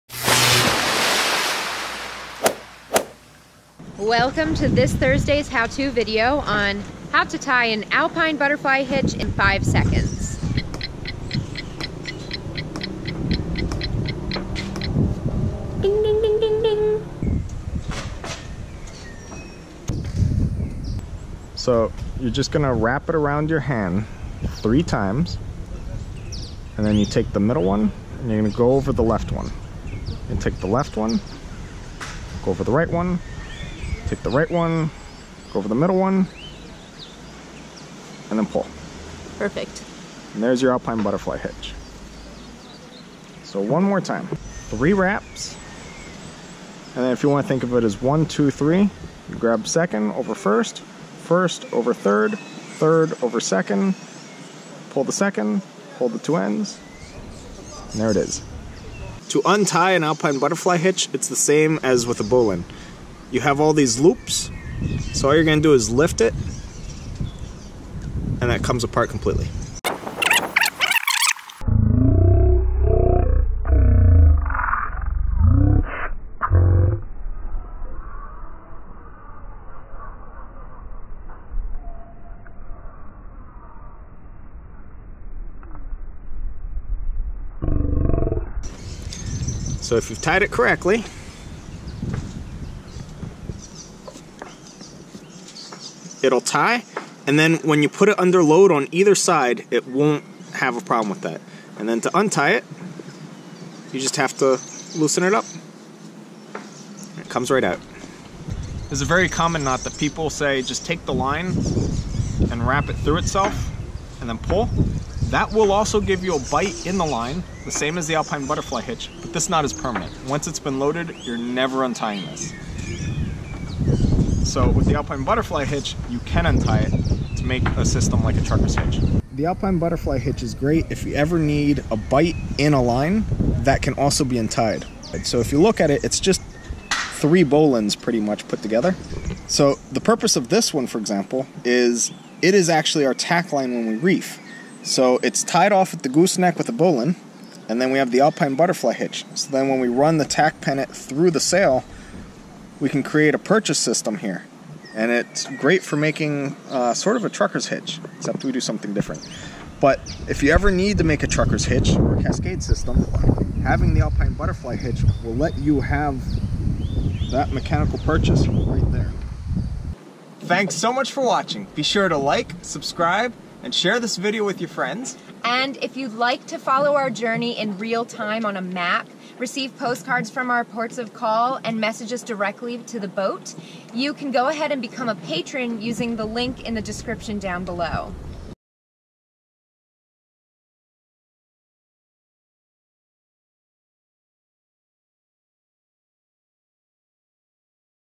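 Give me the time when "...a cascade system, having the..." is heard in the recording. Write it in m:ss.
2:42.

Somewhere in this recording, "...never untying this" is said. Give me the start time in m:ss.
2:01.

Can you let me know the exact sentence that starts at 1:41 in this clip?
And then to untie it, you just have to loosen it up.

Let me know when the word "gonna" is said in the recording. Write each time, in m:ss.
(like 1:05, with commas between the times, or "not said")
0:22, 0:28, 1:05.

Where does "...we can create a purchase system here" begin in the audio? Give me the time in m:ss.
2:32.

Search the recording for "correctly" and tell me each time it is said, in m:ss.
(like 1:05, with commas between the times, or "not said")
1:30.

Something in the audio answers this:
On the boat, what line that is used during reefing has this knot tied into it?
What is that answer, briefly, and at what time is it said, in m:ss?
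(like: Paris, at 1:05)
tack line, at 2:23.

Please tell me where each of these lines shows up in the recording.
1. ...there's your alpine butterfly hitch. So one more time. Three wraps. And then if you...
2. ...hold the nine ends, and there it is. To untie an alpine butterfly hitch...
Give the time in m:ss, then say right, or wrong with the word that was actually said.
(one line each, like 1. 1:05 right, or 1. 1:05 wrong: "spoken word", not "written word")
1. 0:40 right
2. 0:55 wrong: "two", not "nine".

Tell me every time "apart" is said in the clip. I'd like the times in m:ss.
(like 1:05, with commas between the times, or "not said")
1:08.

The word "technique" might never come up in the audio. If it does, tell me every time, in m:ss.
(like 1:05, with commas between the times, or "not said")
not said.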